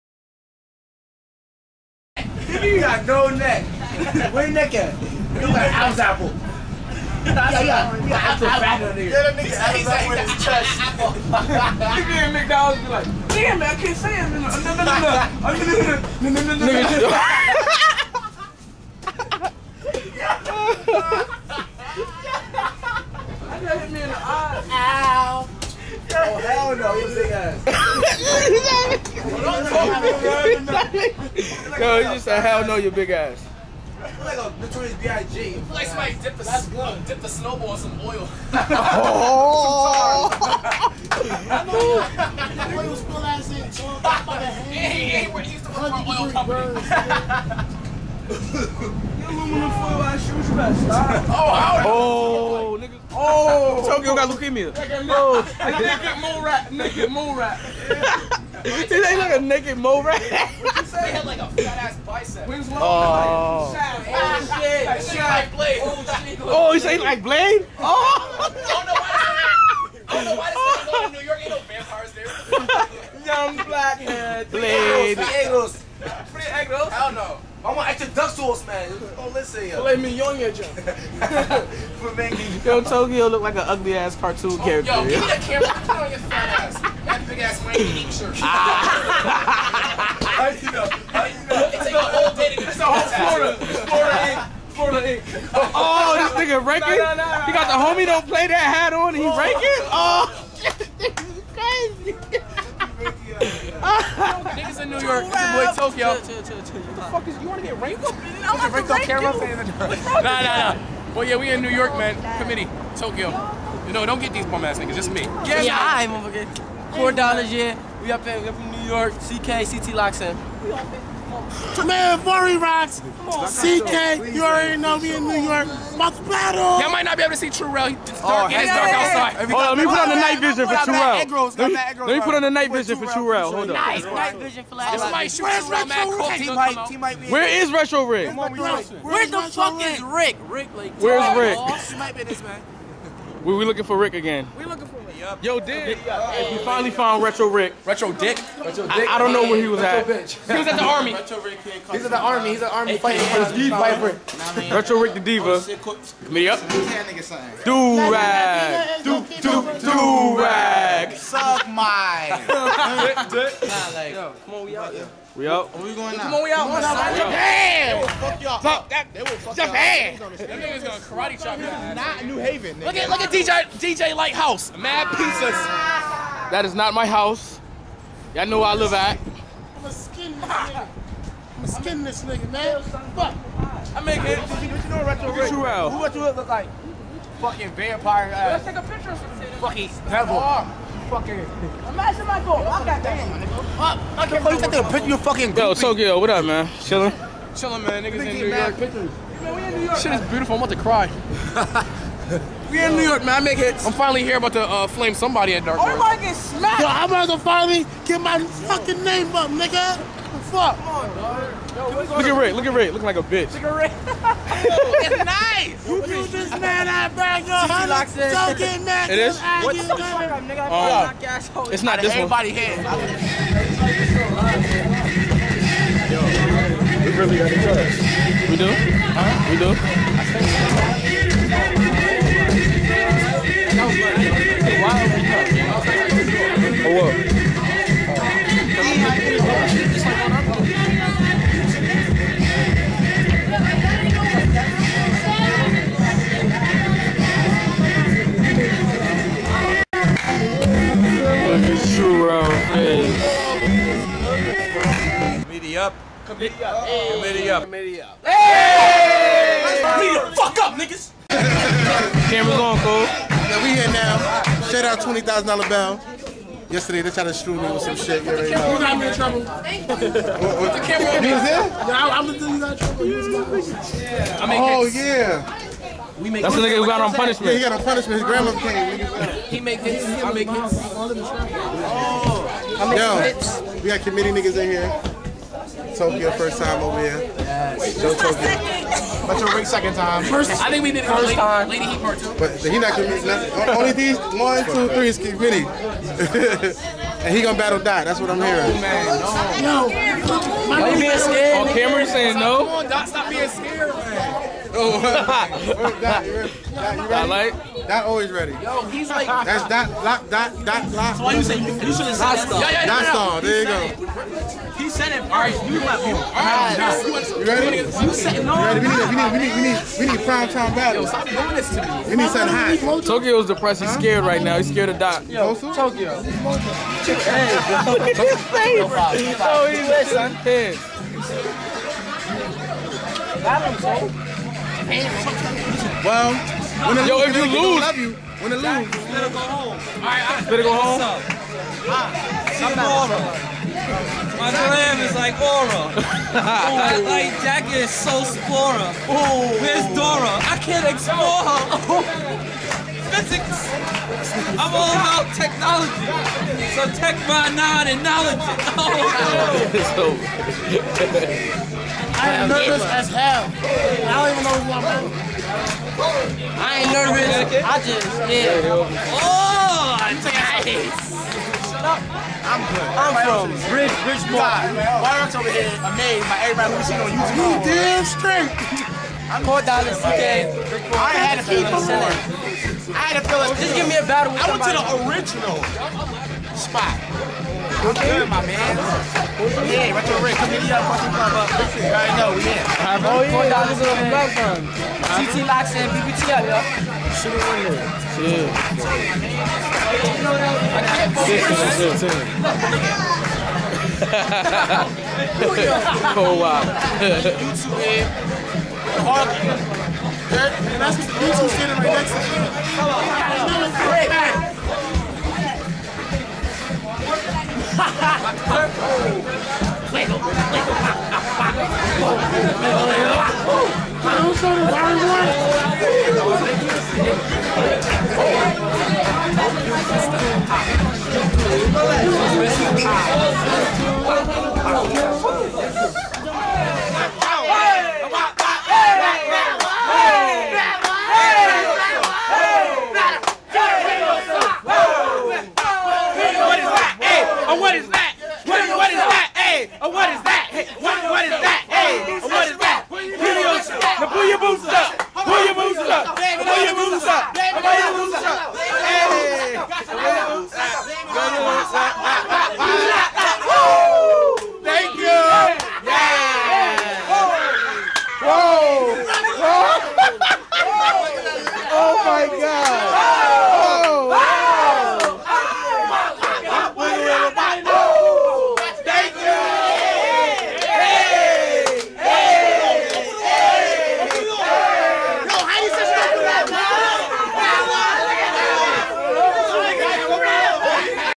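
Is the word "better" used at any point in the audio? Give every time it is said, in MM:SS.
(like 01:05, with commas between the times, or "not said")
00:50, 05:40.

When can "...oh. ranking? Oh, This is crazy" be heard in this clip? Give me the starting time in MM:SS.
01:39.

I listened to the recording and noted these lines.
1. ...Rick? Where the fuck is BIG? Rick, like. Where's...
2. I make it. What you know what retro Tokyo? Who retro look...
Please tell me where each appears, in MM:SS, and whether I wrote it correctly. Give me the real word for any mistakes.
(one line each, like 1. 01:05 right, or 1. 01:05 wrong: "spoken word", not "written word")
1. 02:18 wrong: "Rick", not "BIG"
2. 03:03 wrong: "Rich", not "Tokyo".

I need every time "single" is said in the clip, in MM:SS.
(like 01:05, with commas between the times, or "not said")
not said.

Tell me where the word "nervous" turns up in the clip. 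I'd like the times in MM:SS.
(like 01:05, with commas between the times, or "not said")
06:02, 06:06.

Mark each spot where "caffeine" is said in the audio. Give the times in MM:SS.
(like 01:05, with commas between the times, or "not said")
not said.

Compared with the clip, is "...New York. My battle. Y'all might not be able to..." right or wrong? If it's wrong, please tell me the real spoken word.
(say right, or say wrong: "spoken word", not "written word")
right.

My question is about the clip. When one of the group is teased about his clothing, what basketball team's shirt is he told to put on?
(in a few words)
Miami Heat.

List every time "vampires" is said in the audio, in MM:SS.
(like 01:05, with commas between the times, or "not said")
01:11, 03:07.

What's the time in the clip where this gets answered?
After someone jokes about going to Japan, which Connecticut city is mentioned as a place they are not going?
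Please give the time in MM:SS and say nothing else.
02:52.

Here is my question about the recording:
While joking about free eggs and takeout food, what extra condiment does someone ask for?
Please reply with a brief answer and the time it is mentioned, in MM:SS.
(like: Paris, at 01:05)
duck sauce, at 01:18.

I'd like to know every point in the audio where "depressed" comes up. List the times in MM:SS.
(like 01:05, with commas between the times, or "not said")
05:23.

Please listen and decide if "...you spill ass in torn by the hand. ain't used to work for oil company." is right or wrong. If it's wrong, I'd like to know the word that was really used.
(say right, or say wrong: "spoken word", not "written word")
right.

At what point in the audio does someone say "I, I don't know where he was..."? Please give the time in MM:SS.
02:29.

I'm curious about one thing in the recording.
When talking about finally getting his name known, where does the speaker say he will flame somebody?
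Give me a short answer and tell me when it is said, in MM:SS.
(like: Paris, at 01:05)
Dark Wars, at 03:25.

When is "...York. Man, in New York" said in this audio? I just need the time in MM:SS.
03:18.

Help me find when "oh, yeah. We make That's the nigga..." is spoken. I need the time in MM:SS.
04:34.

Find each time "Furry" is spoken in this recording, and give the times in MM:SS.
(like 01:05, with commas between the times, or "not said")
02:02.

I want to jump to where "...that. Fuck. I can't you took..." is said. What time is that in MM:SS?
03:13.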